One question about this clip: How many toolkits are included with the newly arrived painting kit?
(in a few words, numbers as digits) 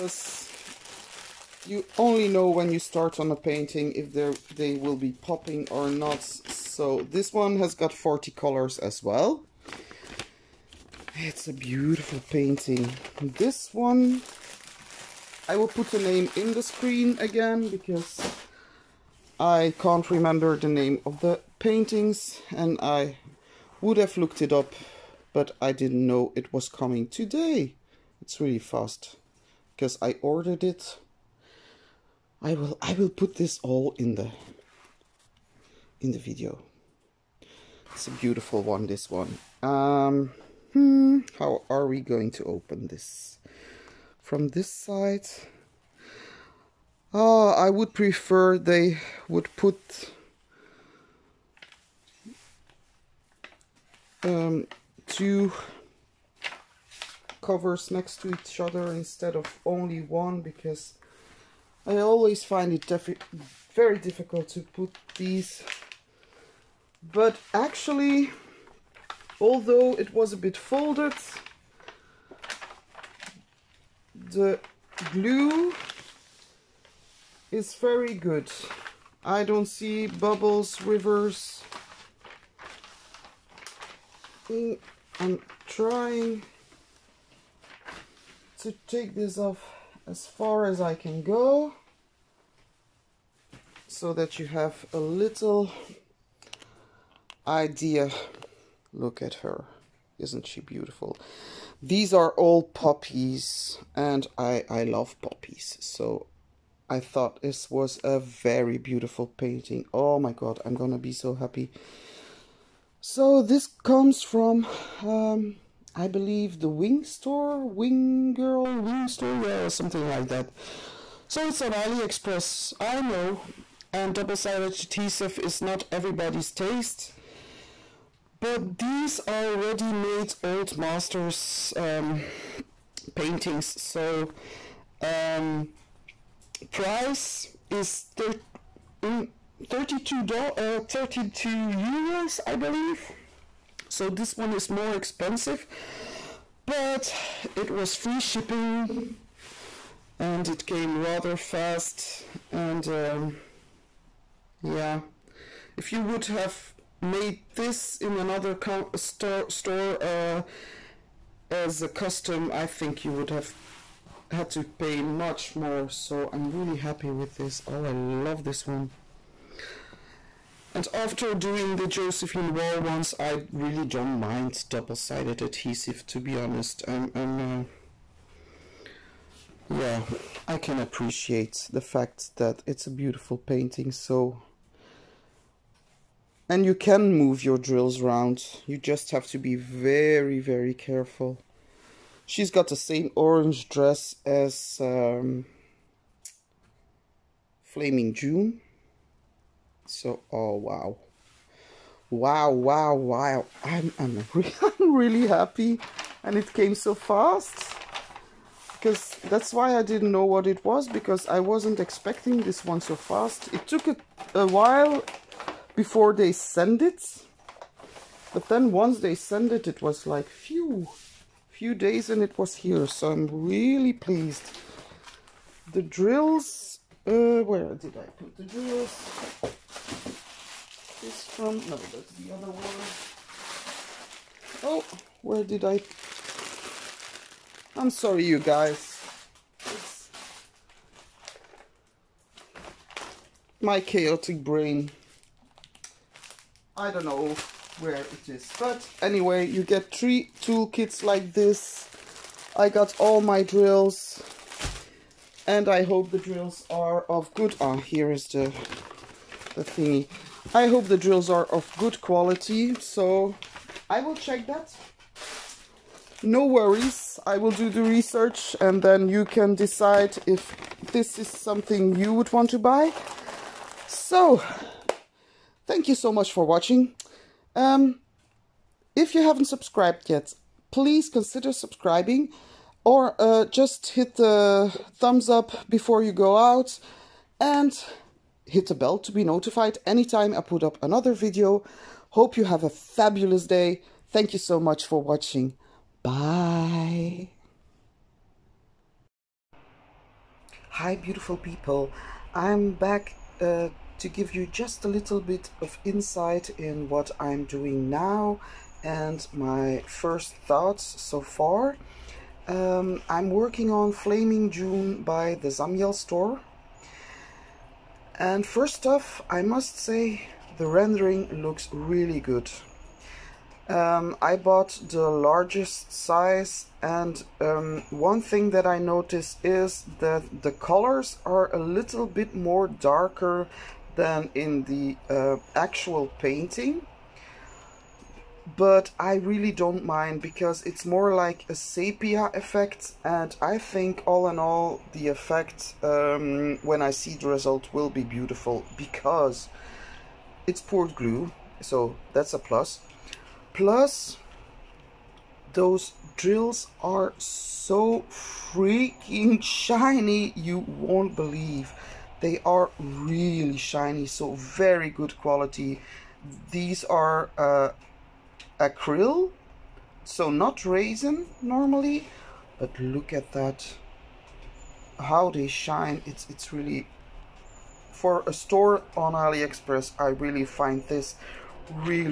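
Three.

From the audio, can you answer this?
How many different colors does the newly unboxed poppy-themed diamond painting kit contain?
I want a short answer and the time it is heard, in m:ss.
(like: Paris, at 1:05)
40, at 0:07.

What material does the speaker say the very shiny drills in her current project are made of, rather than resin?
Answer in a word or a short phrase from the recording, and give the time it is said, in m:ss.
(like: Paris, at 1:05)
Acrylic, at 6:08.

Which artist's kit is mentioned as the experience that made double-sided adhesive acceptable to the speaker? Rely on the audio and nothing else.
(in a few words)
Josephine Wall.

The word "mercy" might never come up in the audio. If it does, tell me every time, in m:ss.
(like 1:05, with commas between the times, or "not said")
not said.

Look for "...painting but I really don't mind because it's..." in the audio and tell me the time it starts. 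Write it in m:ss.
5:36.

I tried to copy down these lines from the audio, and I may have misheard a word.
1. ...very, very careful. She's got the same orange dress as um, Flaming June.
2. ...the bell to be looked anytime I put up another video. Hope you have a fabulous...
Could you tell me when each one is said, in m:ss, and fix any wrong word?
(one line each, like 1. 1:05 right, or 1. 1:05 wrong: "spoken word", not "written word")
1. 3:09 right
2. 4:48 wrong: "notified", not "looked".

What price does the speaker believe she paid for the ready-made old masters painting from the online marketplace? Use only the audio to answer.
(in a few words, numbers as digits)
32 euros.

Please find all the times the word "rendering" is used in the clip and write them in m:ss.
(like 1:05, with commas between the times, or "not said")
5:20.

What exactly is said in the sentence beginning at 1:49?
Oh my god, I'm gonna be so happy.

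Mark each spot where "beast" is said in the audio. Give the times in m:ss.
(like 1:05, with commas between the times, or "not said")
not said.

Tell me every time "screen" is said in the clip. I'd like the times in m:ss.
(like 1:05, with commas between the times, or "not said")
0:16.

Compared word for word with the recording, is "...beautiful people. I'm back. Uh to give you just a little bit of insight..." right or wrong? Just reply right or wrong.
right.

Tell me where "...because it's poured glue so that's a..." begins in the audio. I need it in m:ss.
5:48.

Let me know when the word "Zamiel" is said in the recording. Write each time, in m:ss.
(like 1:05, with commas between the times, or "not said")
5:15.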